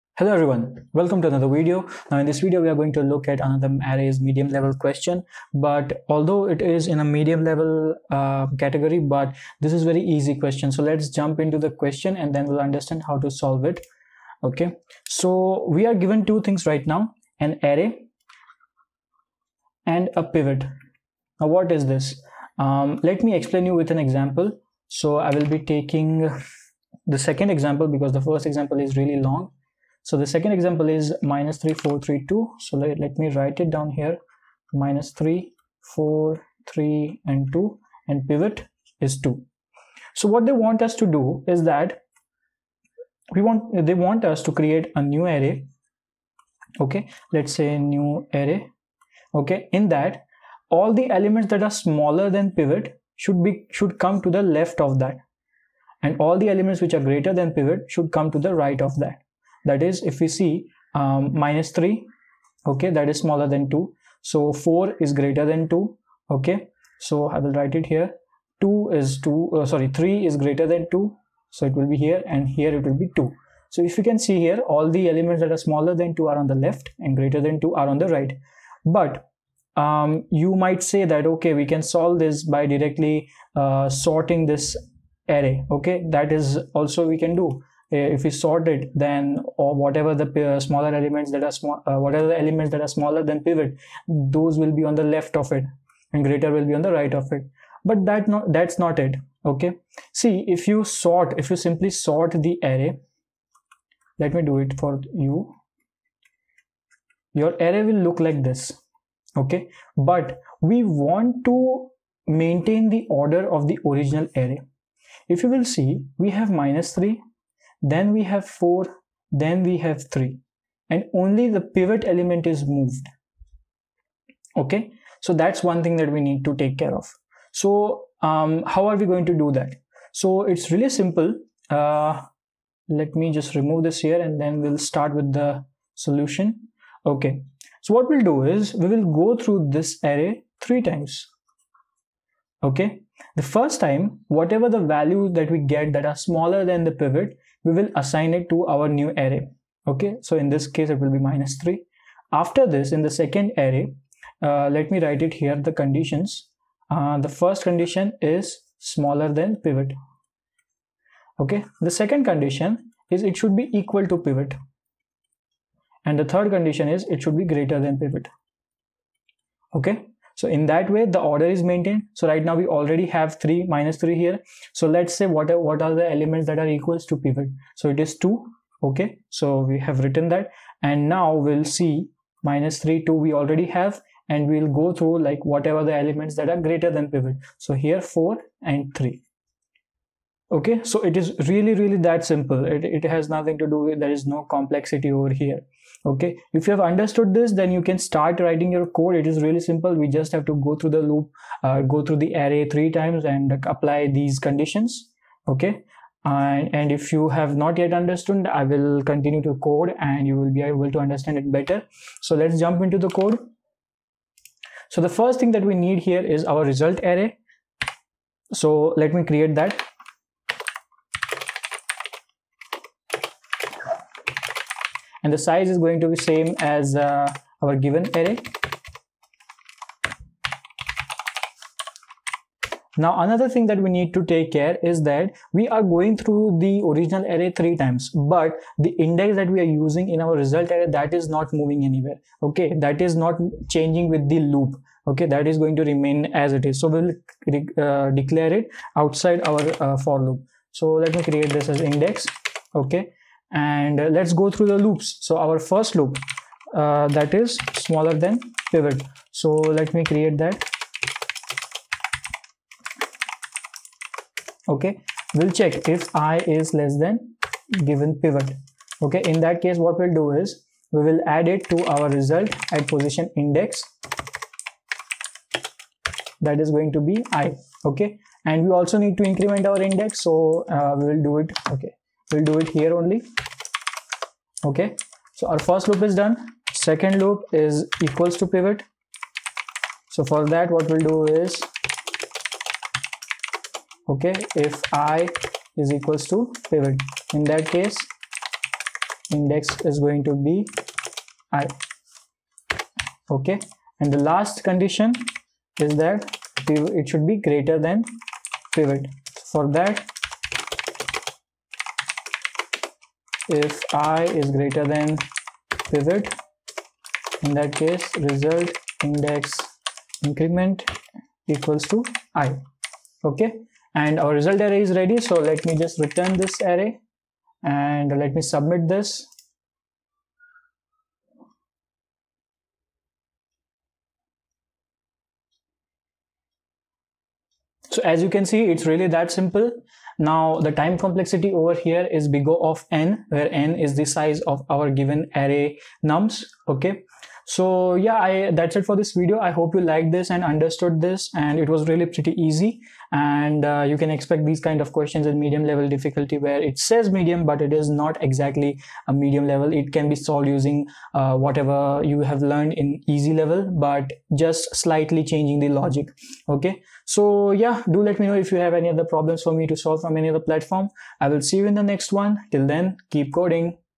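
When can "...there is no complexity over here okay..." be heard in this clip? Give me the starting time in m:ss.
3:14.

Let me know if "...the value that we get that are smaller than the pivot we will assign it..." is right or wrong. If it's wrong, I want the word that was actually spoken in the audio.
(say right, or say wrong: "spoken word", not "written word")
right.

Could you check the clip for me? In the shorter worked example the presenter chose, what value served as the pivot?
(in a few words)
2.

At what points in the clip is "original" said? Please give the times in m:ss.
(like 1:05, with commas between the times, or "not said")
1:53, 3:56.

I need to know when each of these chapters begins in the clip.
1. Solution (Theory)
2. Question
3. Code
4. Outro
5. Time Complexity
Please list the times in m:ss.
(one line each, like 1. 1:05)
1. 2:17
2. 0:11
3. 3:33
4. 5:52
5. 5:40.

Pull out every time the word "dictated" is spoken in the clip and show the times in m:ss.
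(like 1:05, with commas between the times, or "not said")
not said.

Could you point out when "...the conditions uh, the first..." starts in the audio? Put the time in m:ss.
2:35.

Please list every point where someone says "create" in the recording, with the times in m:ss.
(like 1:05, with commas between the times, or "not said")
0:44, 3:39, 4:11, 4:20.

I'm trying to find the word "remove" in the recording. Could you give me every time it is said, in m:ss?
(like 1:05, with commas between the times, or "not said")
2:13.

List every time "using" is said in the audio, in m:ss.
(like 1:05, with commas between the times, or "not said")
3:59, 6:00.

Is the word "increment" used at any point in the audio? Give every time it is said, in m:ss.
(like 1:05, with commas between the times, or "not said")
4:39, 5:20.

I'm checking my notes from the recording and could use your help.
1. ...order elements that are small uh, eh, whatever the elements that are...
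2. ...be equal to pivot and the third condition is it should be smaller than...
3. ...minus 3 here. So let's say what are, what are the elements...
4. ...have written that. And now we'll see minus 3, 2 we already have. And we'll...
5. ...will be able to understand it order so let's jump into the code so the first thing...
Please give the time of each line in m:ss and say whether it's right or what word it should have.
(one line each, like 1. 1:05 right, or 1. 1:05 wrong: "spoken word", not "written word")
1. 1:30 wrong: "smaller", not "order"
2. 2:43 wrong: "greater", not "smaller"
3. 2:53 right
4. 2:59 right
5. 3:30 wrong: "better", not "order".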